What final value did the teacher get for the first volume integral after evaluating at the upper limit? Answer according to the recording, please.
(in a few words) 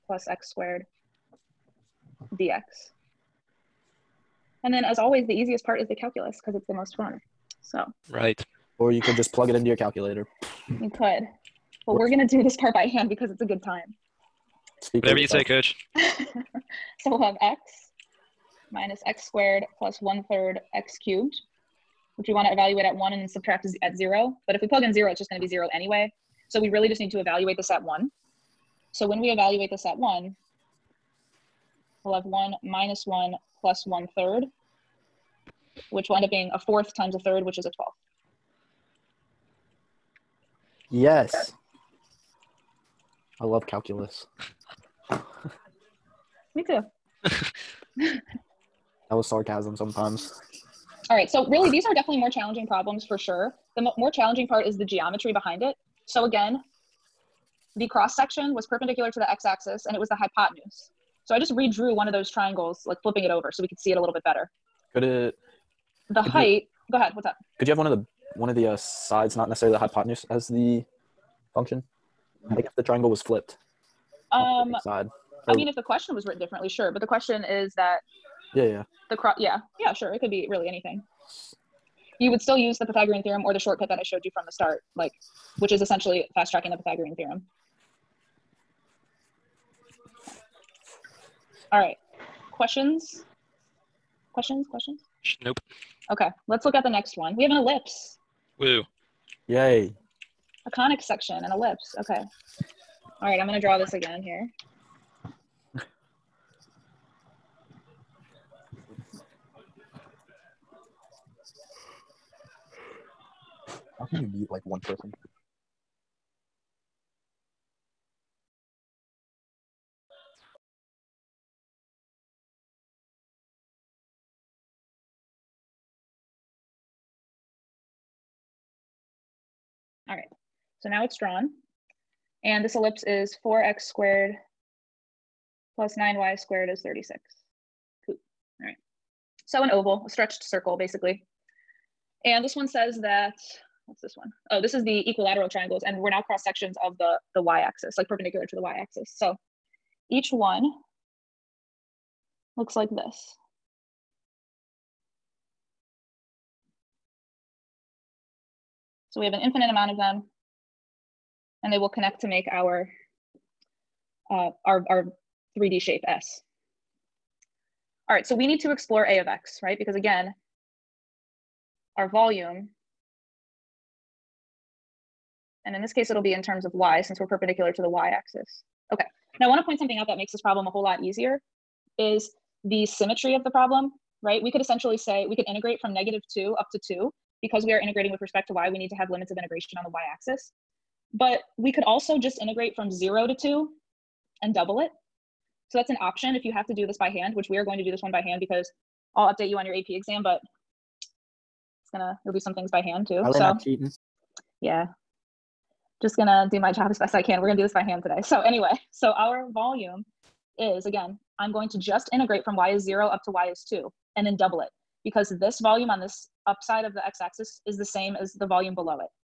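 1/12.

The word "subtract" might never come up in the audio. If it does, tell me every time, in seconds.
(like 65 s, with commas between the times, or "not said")
23 s.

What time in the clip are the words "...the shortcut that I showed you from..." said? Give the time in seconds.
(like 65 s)
83 s.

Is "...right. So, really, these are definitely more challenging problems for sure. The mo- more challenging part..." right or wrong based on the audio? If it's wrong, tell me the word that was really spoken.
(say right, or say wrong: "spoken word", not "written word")
right.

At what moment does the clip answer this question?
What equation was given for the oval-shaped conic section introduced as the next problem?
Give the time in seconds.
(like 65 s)
133 s.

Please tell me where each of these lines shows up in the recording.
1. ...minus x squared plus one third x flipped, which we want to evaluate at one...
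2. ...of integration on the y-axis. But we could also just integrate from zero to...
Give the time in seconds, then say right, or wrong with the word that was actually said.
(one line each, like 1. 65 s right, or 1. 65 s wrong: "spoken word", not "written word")
1. 18 s wrong: "cubed", not "flipped"
2. 189 s right.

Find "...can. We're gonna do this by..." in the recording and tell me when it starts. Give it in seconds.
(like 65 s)
207 s.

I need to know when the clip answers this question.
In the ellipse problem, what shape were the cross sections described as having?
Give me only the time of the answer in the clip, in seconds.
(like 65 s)
145 s.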